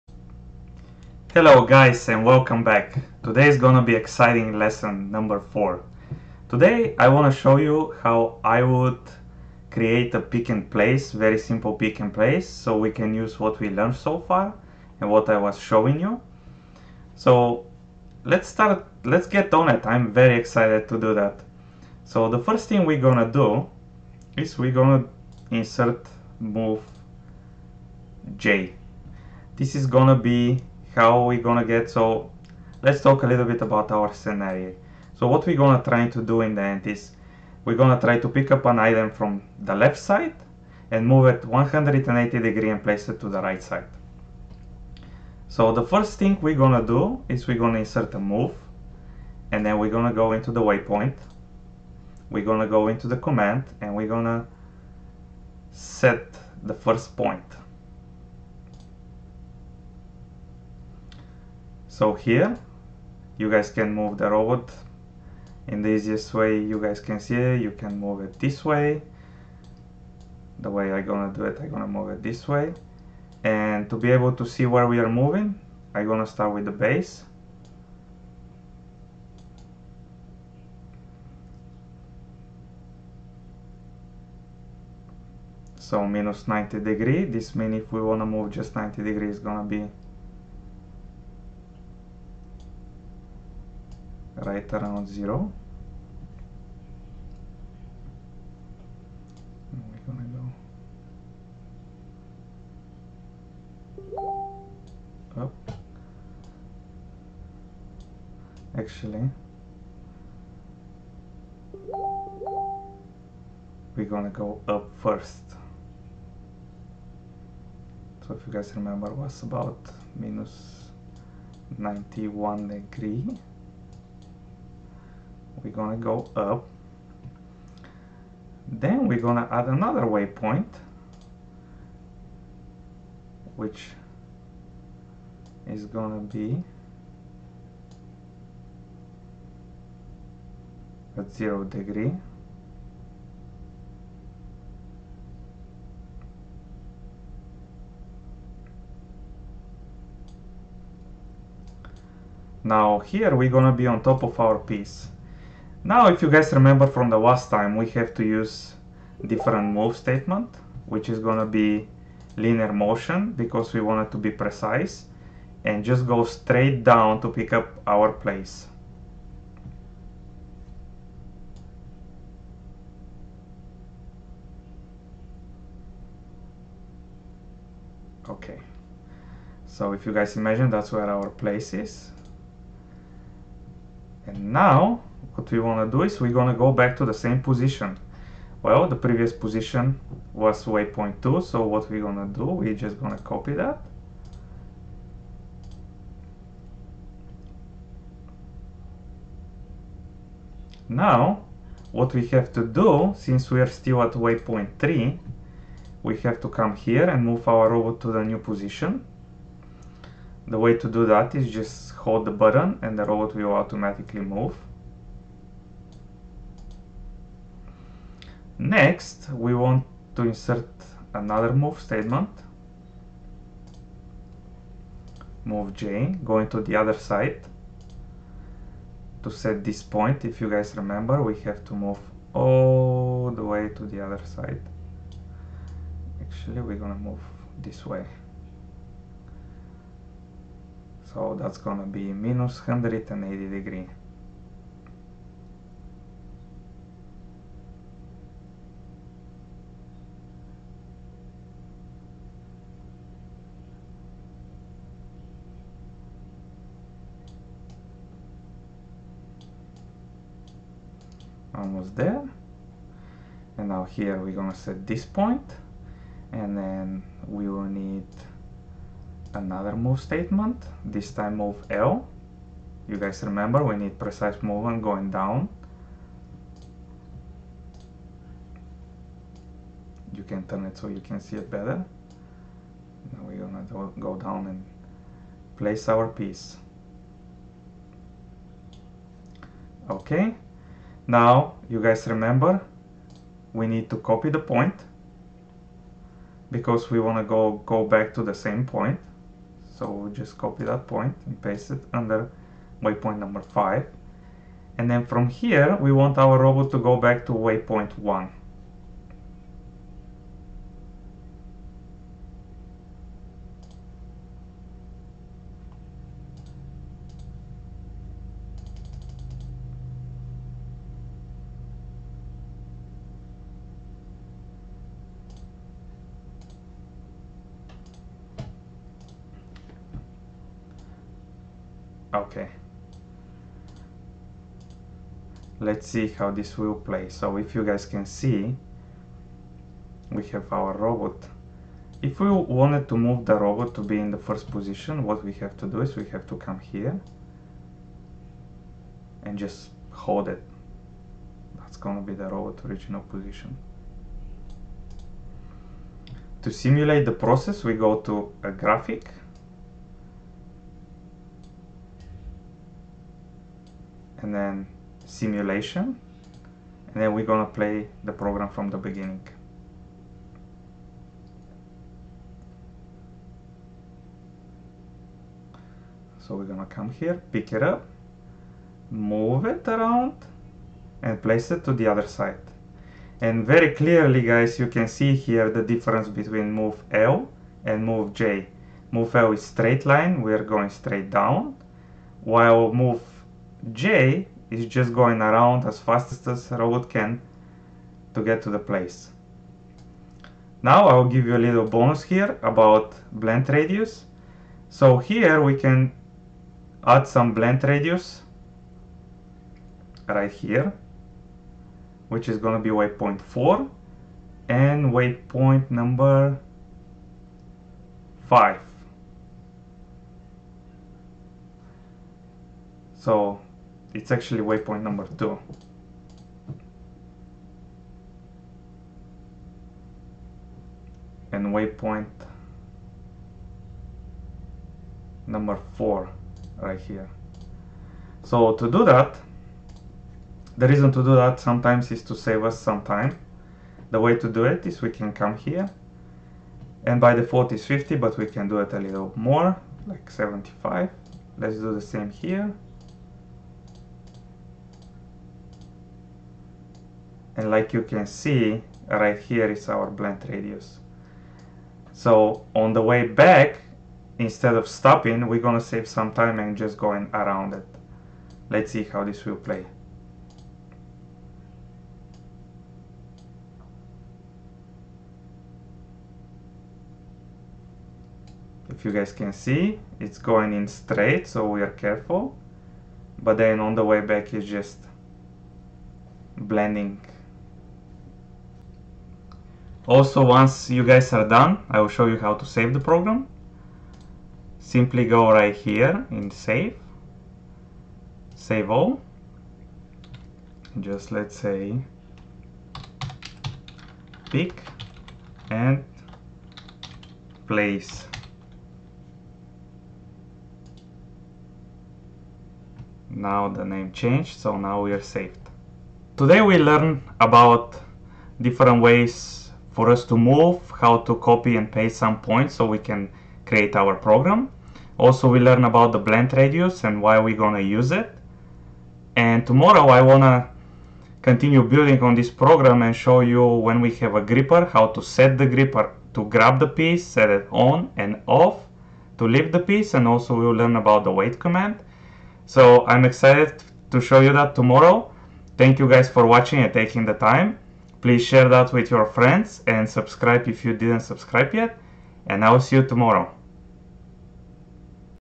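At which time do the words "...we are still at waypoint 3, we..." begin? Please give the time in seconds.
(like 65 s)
203 s.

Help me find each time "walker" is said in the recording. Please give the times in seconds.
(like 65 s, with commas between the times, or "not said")
not said.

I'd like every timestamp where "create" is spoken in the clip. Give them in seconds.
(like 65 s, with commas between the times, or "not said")
9 s, 523 s.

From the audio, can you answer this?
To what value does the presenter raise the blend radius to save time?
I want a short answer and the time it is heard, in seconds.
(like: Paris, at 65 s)
75, at 450 s.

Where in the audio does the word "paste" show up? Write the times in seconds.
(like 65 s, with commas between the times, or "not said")
301 s, 521 s.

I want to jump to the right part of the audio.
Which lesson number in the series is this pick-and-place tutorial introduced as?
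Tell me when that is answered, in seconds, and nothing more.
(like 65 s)
4 s.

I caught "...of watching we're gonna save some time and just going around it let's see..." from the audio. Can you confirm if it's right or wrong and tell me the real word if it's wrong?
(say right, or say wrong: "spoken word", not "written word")
wrong: "stopping", not "watching".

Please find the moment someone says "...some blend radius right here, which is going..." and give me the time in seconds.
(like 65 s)
407 s.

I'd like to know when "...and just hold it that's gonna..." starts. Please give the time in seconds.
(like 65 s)
349 s.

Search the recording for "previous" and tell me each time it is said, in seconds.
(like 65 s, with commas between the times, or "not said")
188 s.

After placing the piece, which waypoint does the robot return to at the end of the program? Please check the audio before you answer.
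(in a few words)
waypoint 1.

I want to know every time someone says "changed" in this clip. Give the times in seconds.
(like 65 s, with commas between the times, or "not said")
513 s.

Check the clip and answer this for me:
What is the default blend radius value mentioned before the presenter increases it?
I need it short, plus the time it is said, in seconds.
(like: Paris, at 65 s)
50, at 447 s.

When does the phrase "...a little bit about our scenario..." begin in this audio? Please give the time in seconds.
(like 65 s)
33 s.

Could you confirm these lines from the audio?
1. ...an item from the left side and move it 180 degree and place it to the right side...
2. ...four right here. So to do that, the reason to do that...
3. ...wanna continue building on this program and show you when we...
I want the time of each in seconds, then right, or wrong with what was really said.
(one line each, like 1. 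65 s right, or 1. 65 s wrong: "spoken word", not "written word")
1. 38 s right
2. 435 s right
3. 530 s right.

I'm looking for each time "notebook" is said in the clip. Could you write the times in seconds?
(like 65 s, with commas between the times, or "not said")
not said.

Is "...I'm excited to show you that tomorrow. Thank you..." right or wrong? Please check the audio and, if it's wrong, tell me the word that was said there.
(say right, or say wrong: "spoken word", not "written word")
right.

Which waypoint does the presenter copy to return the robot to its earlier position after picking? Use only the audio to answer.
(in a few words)
waypoint 2.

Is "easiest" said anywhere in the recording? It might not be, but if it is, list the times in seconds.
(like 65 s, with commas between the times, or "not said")
65 s.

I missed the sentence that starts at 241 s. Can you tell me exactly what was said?
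So that's gonna be minus 180 degree.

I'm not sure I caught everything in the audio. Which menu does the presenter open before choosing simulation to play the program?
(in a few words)
graphic.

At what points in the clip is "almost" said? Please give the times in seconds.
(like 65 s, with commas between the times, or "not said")
261 s.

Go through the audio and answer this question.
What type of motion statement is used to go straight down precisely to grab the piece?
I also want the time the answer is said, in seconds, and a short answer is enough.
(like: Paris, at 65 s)
linear motion, at 162 s.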